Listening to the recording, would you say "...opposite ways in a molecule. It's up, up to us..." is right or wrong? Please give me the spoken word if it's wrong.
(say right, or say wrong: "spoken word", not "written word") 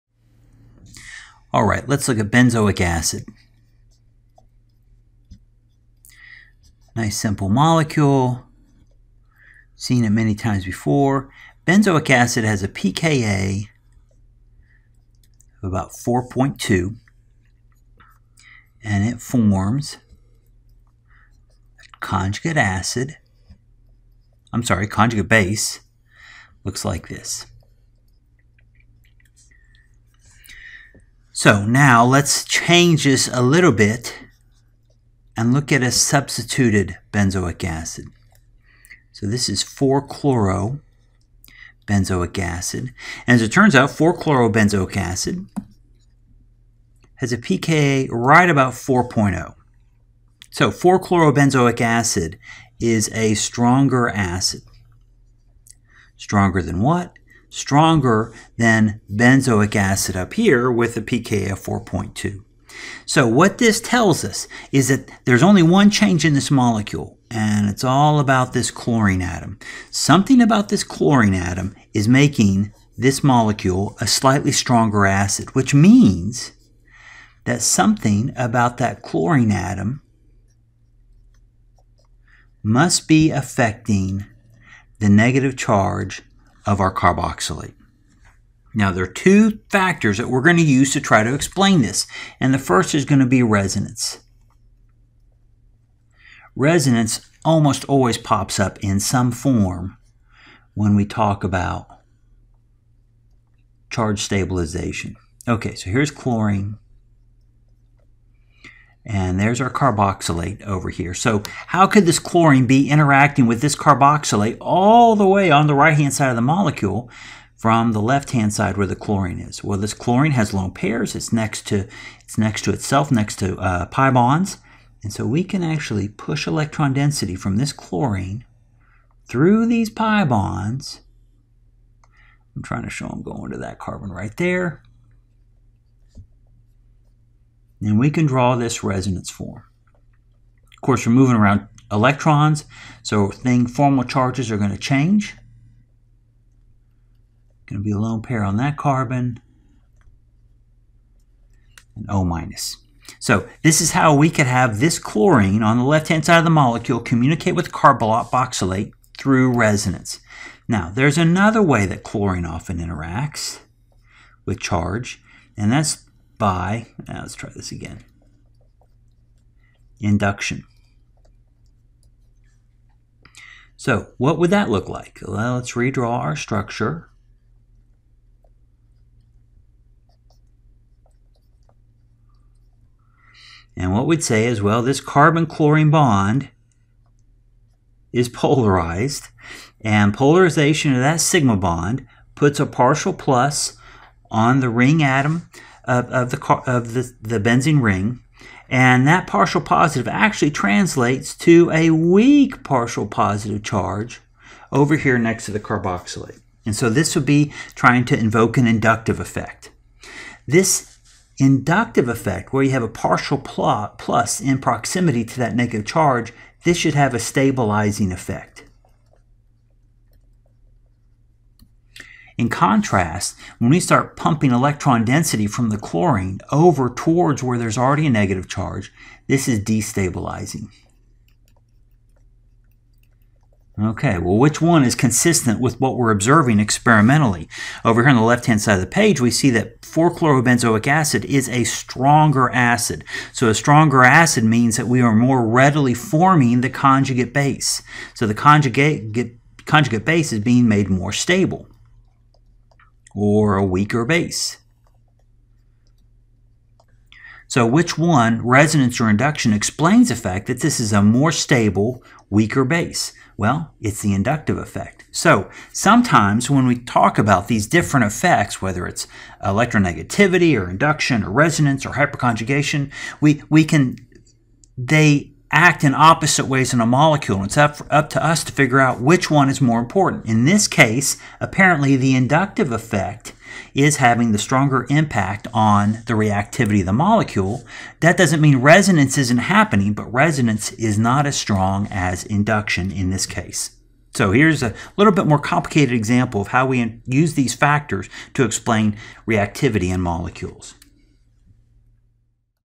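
right.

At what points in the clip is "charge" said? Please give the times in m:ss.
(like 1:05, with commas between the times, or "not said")
1:25, 1:43, 2:24, 2:44, 3:23, 3:35, 3:48.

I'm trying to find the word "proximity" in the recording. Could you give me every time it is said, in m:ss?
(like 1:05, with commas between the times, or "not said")
3:34.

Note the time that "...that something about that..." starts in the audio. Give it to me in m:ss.
1:17.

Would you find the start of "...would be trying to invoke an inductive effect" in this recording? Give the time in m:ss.
3:27.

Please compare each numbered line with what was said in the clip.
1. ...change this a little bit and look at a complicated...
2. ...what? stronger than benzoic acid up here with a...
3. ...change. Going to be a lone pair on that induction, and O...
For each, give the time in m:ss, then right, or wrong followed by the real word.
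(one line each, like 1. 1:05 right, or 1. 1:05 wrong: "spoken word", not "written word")
1. 0:32 wrong: "substituted", not "complicated"
2. 0:56 right
3. 2:24 wrong: "carbon", not "induction".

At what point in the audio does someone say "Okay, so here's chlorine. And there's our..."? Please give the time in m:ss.
1:45.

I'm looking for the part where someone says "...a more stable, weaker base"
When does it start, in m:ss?
4:20.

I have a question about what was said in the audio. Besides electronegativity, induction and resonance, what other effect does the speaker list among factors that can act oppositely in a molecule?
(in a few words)
Hyperconjugation.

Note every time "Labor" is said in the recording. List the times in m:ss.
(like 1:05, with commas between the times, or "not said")
not said.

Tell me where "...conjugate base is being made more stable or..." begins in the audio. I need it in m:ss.
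4:09.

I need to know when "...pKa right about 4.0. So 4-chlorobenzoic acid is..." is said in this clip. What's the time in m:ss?
0:47.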